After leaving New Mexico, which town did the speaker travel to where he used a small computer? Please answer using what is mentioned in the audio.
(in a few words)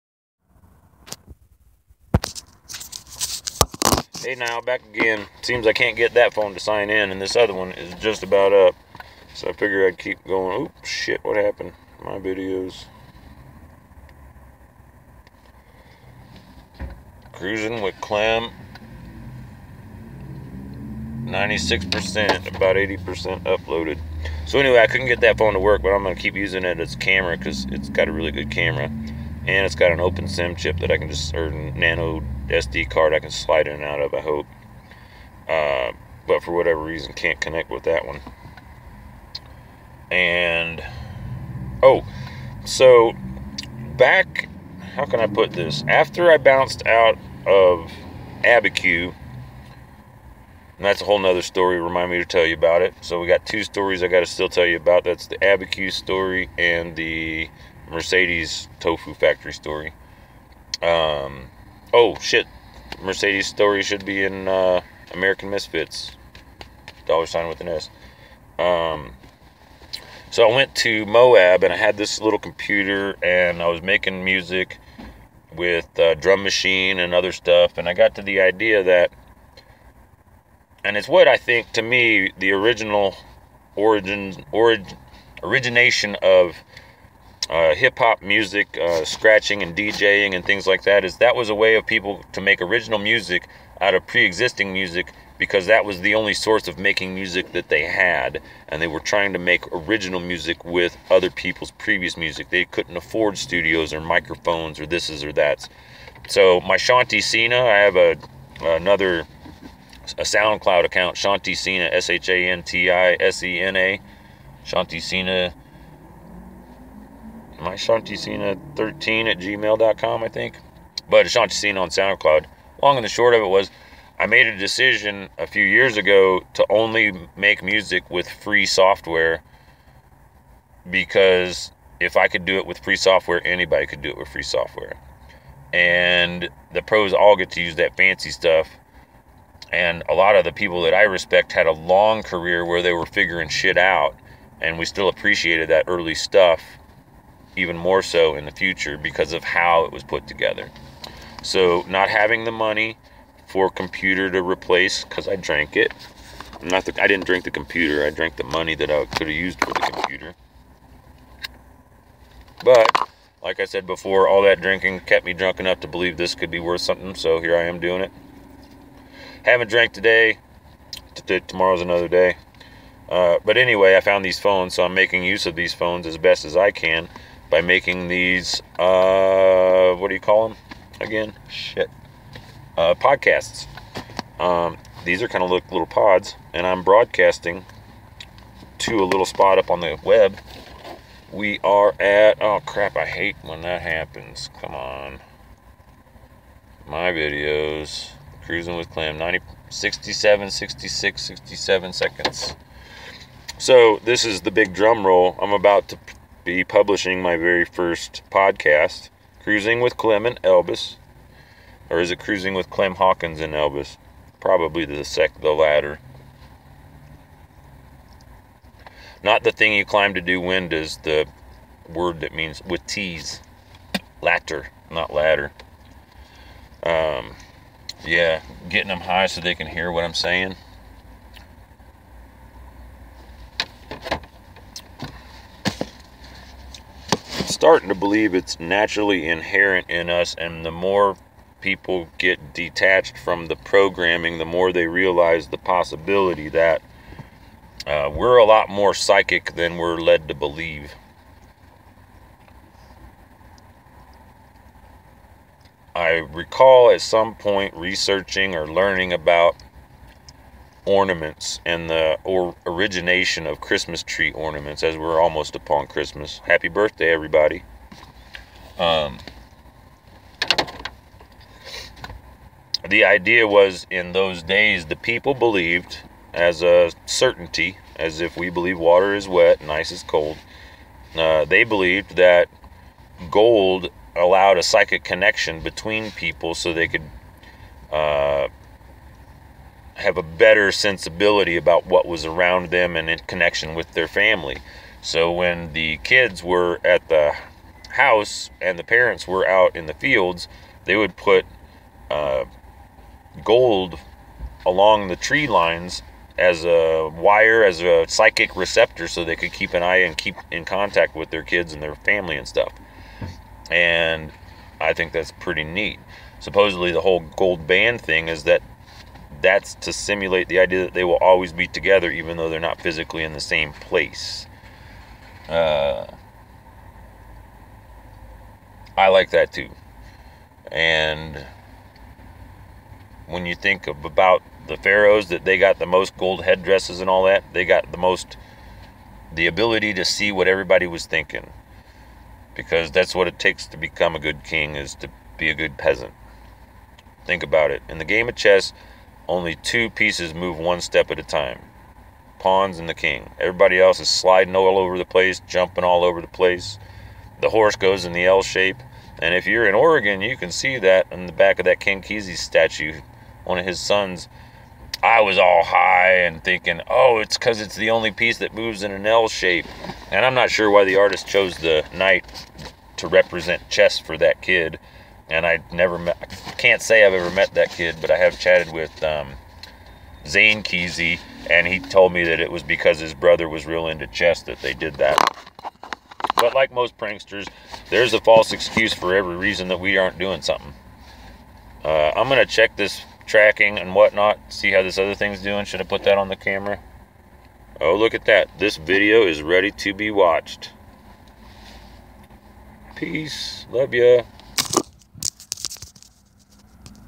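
Moab.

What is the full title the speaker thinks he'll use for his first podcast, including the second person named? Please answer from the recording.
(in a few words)
Cruising with Clem Hawkins and Elvis.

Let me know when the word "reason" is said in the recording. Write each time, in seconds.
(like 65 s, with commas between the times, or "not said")
36 s, 389 s.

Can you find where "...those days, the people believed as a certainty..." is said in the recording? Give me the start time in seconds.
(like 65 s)
274 s.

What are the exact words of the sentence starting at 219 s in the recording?
Not the thing you climb to do wind is the word that means with T's.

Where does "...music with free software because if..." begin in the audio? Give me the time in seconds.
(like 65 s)
127 s.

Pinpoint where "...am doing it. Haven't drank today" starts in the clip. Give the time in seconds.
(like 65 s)
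167 s.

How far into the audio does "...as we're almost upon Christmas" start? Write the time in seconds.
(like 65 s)
264 s.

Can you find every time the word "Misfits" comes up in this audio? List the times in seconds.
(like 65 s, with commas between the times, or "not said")
65 s.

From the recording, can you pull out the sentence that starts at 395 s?
Should I put that on the camera?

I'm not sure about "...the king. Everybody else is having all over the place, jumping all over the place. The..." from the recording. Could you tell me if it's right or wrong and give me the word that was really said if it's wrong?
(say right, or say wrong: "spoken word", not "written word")
wrong: "sliding", not "having".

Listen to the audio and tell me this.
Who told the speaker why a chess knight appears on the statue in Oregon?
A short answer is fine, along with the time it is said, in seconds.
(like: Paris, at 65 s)
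Zane Kesey, at 380 s.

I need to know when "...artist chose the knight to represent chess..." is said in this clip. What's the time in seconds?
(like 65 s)
370 s.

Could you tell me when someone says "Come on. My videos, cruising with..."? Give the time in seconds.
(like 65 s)
194 s.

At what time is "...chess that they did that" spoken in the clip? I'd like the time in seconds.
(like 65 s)
384 s.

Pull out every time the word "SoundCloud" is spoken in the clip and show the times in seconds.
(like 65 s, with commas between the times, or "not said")
110 s, 121 s.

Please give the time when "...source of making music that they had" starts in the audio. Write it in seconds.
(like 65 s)
96 s.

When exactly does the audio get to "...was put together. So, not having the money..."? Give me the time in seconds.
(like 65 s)
149 s.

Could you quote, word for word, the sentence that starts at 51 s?
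Remind me to tell you about it.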